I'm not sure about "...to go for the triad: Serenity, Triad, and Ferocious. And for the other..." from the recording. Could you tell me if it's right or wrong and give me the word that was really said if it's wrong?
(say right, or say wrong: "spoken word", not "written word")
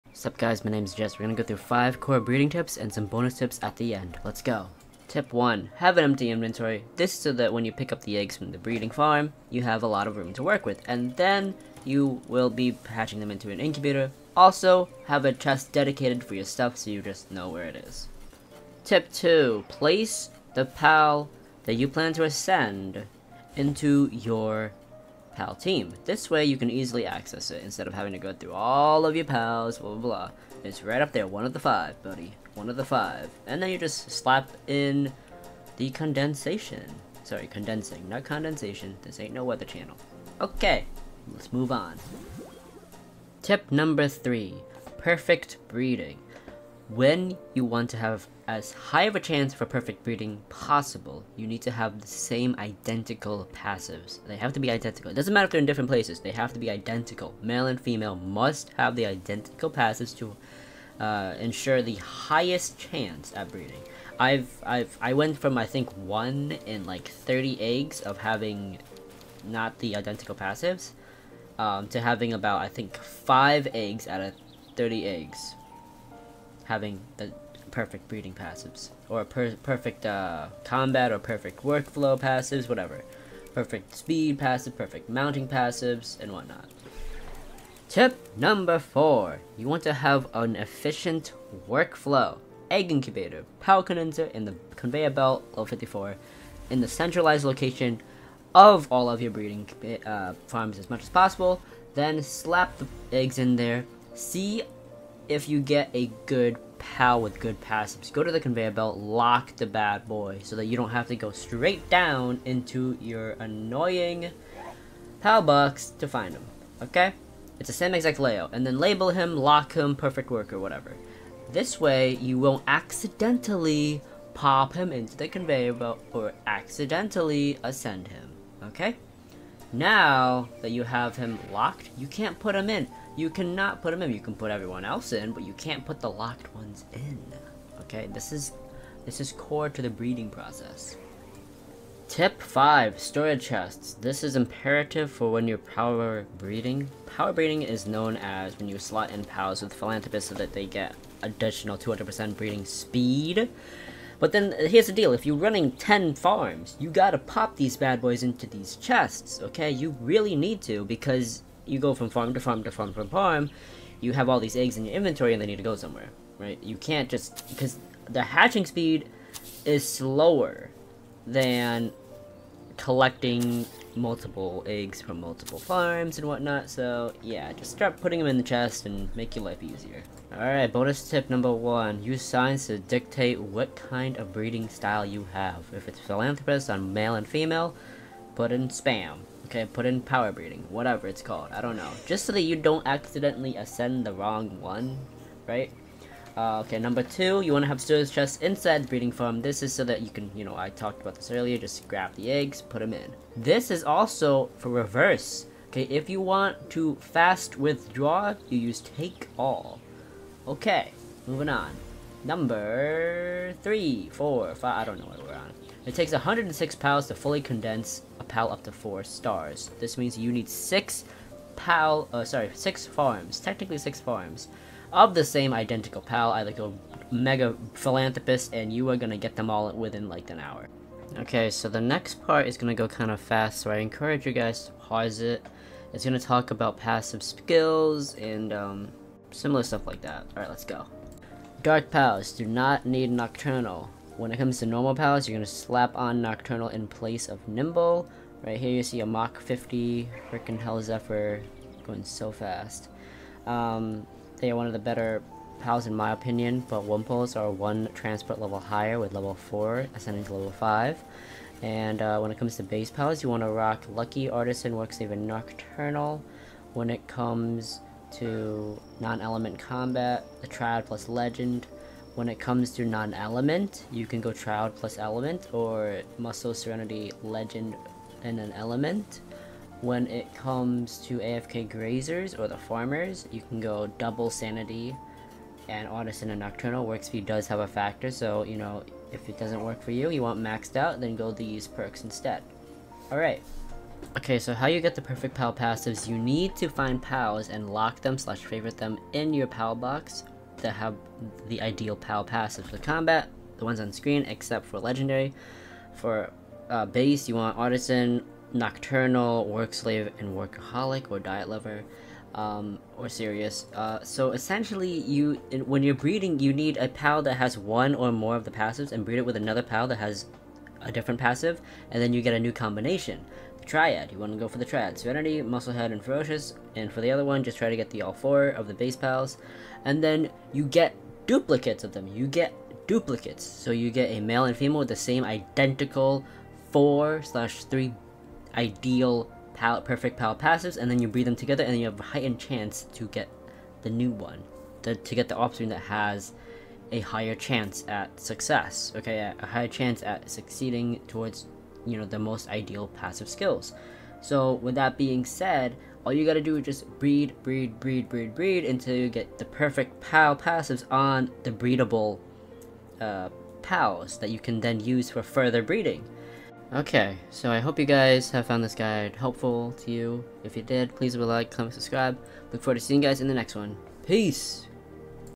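wrong: "Musclehead", not "Triad".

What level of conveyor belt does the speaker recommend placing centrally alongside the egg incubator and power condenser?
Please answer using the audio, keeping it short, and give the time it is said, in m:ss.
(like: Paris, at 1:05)
54, at 1:35.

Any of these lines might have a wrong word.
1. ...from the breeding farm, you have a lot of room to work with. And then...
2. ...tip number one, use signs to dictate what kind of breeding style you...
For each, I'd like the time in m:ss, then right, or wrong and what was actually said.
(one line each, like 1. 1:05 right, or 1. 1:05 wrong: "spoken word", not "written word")
1. 0:08 right
2. 3:01 right.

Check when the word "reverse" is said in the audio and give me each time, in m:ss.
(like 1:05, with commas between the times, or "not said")
3:24.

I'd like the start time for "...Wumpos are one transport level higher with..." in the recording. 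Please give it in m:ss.
4:16.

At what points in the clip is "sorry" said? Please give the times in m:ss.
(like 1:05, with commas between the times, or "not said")
0:37, 3:42.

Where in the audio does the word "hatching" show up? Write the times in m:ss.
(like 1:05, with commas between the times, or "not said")
0:12, 2:48.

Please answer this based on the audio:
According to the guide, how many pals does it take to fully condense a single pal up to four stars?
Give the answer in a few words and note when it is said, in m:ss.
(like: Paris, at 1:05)
106, at 3:36.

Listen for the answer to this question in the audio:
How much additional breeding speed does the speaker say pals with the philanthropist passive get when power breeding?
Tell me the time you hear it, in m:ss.
2:31.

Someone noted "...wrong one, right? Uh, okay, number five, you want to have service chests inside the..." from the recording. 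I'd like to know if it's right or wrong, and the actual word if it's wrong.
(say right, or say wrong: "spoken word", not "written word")
wrong: "two", not "five".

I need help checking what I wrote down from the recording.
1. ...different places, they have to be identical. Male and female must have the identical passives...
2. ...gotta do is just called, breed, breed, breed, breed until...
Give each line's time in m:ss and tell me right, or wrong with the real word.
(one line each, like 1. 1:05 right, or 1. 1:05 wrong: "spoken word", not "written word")
1. 0:55 right
2. 5:56 wrong: "breed", not "called".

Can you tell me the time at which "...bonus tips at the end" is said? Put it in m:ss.
0:03.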